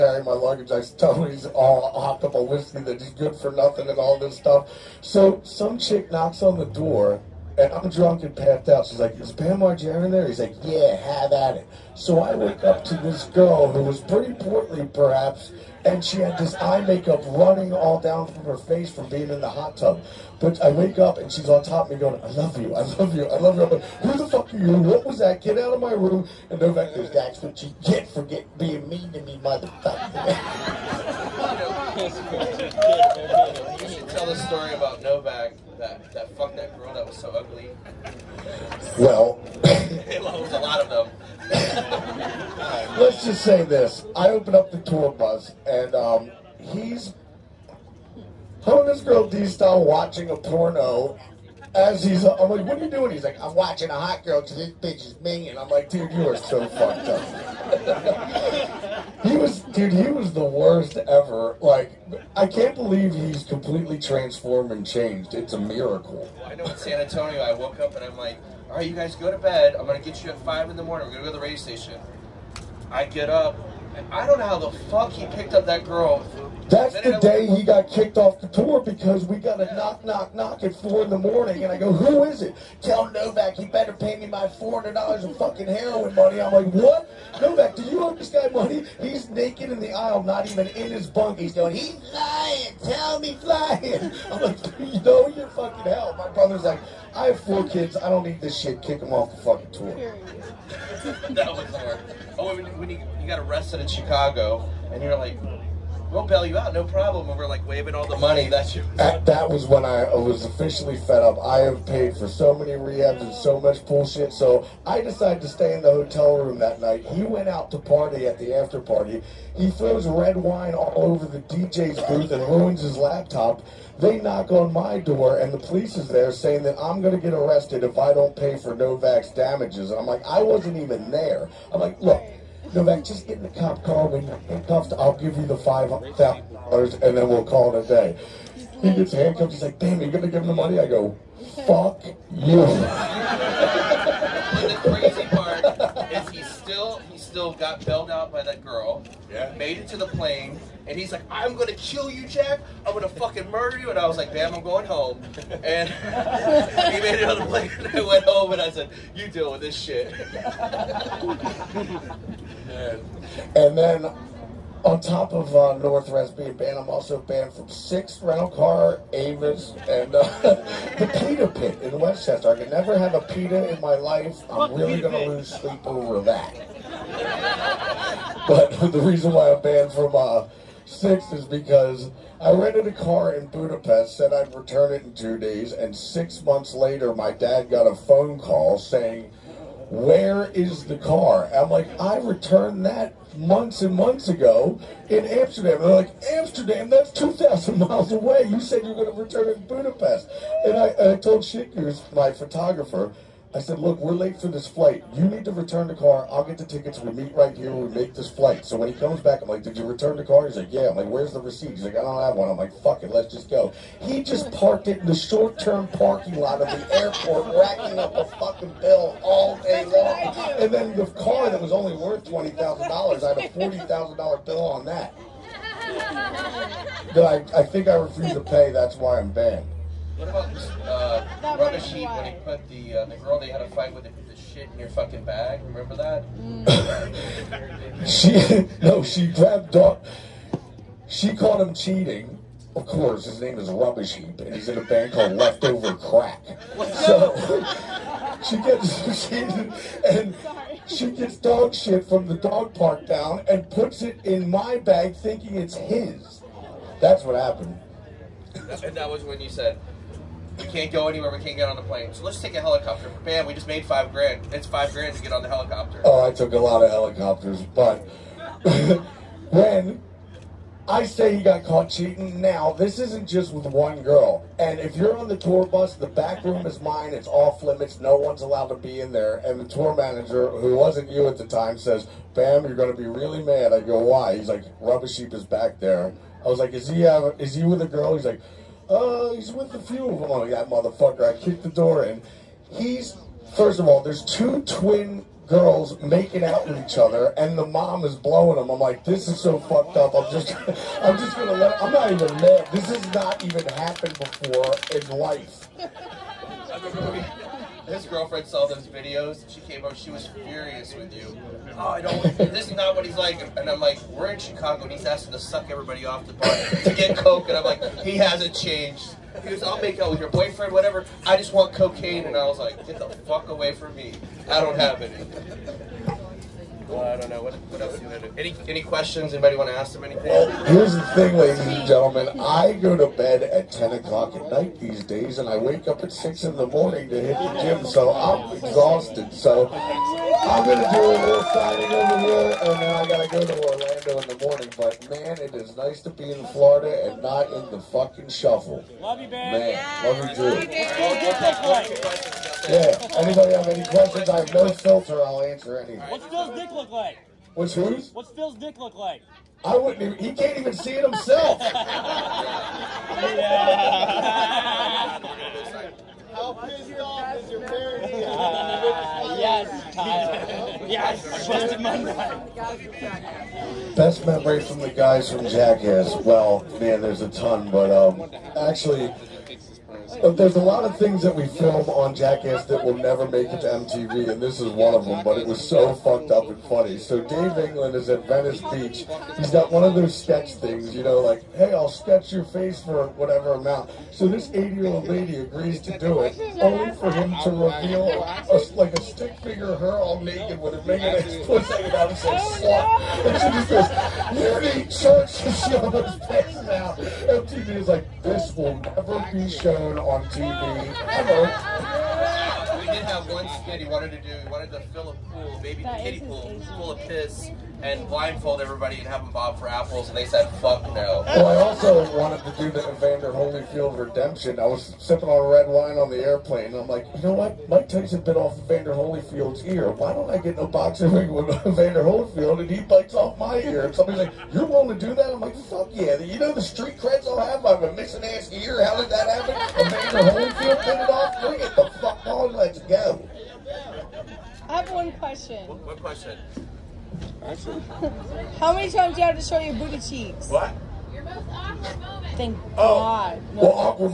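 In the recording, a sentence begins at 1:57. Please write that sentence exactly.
He went out to party at the after party.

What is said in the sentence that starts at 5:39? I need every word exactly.
So I'm going to do a little signing over here, and then I got to go to Orlando in the morning.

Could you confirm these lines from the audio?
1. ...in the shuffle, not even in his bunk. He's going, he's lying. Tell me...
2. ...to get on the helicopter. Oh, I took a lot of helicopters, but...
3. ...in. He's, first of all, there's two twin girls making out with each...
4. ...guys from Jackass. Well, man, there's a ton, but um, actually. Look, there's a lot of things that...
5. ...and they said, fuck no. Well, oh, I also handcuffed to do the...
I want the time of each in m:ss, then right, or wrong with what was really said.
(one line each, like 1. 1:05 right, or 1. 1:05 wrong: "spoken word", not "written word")
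1. 1:29 wrong: "aisle", not "shuffle"
2. 4:25 right
3. 4:52 right
4. 6:14 right
5. 7:00 wrong: "wanted", not "handcuffed".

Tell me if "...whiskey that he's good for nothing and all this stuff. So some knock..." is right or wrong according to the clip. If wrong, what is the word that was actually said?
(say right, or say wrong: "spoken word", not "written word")
wrong: "chick", not "knock".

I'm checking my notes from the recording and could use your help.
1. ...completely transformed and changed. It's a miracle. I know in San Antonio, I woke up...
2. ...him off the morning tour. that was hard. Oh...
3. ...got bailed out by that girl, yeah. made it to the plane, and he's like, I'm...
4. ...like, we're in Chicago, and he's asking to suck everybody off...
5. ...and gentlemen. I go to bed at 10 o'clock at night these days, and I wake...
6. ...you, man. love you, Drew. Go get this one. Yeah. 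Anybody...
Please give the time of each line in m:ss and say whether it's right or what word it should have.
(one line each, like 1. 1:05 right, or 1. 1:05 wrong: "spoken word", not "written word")
1. 1:03 right
2. 1:39 wrong: "fucking", not "morning"
3. 2:27 right
4. 5:13 right
5. 5:31 right
6. 5:49 right.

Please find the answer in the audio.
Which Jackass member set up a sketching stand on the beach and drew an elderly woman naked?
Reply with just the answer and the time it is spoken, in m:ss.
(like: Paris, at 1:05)
Dave England, at 6:27.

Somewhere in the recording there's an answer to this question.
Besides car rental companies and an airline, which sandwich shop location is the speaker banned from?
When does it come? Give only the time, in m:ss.
2:50.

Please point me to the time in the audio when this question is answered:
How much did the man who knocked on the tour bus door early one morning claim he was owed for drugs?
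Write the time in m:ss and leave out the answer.
1:24.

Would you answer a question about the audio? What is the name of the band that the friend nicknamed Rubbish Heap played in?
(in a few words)
Leftover Crack.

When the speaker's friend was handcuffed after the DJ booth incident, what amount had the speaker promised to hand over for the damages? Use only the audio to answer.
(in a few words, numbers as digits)
$5,000.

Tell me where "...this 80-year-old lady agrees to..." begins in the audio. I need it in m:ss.
6:34.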